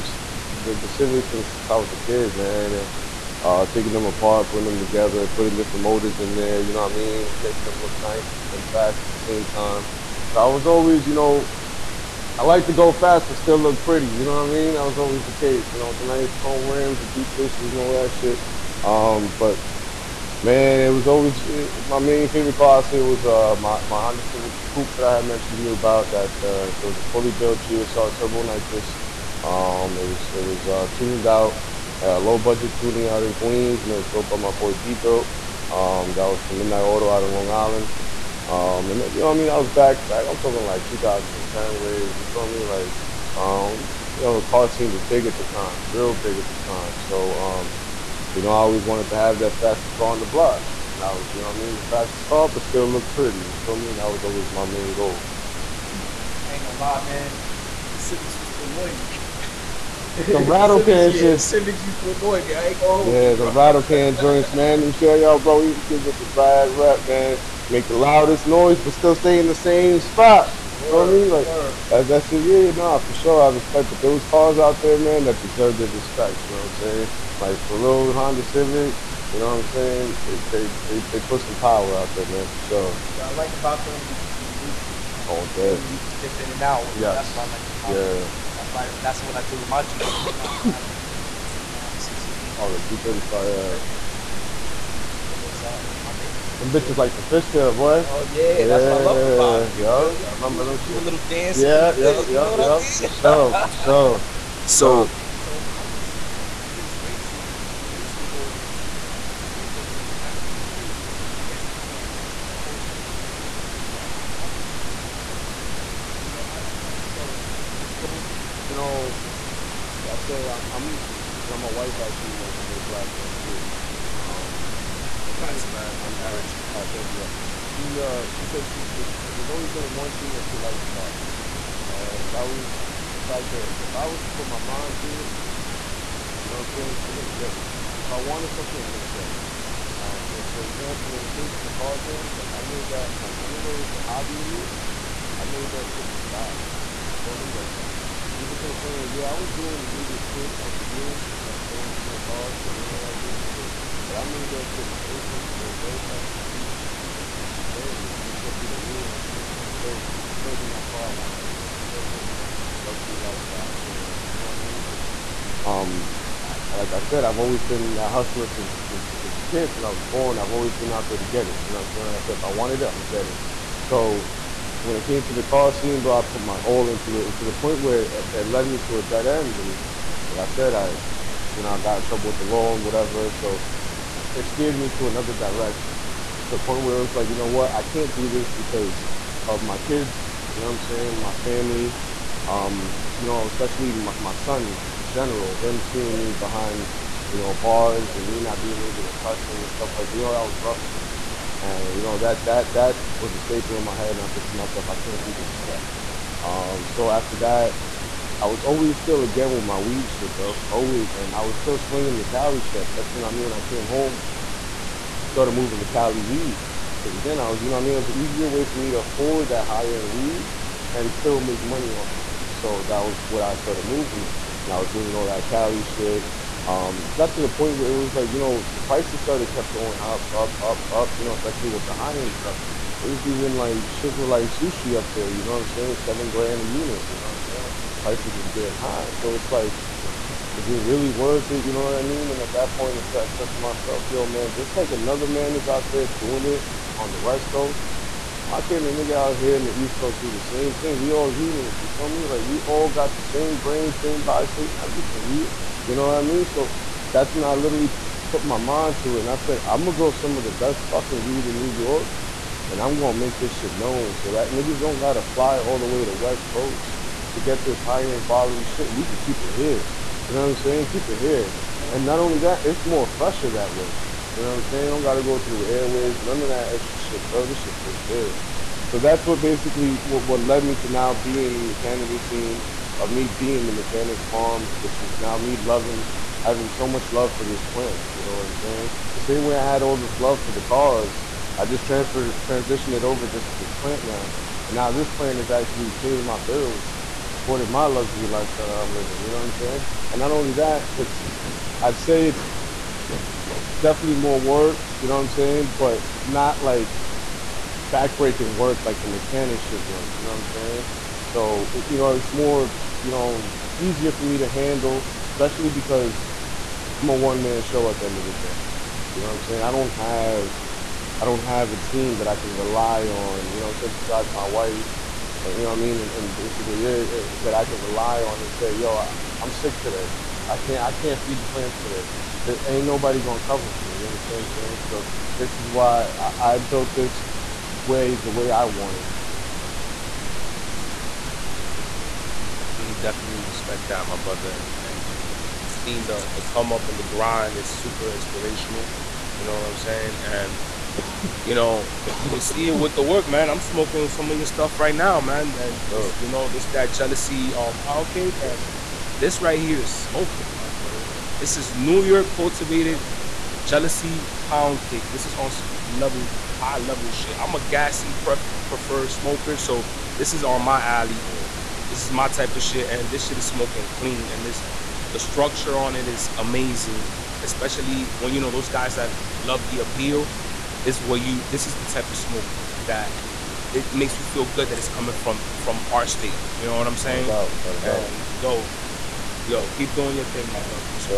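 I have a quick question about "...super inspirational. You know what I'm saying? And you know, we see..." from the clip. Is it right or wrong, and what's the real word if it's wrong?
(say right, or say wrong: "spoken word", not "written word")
right.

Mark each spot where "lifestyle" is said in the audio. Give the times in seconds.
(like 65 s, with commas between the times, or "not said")
163 s, 298 s.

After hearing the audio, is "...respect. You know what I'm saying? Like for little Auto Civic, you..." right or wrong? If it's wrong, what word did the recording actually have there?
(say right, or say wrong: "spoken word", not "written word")
wrong: "Honda", not "Auto".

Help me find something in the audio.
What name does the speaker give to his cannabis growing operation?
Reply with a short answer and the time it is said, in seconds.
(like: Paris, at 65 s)
Mechanics Farm, at 283 s.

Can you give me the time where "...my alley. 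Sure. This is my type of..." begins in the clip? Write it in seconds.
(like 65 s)
370 s.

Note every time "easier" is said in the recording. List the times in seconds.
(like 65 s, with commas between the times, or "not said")
218 s, 313 s.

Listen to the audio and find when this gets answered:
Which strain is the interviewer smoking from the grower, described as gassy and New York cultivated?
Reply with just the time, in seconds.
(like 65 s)
356 s.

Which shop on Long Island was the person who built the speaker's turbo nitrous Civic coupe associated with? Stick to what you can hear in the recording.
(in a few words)
Midnight Auto.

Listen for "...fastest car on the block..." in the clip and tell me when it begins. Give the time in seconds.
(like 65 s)
49 s.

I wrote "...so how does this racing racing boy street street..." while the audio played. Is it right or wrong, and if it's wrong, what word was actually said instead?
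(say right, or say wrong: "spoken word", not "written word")
right.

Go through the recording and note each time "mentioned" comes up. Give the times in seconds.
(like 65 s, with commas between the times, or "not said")
25 s, 122 s.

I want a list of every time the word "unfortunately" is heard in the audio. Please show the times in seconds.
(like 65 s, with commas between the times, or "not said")
not said.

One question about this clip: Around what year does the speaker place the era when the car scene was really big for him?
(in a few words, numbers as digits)
2010.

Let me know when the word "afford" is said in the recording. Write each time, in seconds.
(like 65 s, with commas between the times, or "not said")
218 s.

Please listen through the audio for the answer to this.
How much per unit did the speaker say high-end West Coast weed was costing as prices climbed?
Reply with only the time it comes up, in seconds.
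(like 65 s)
235 s.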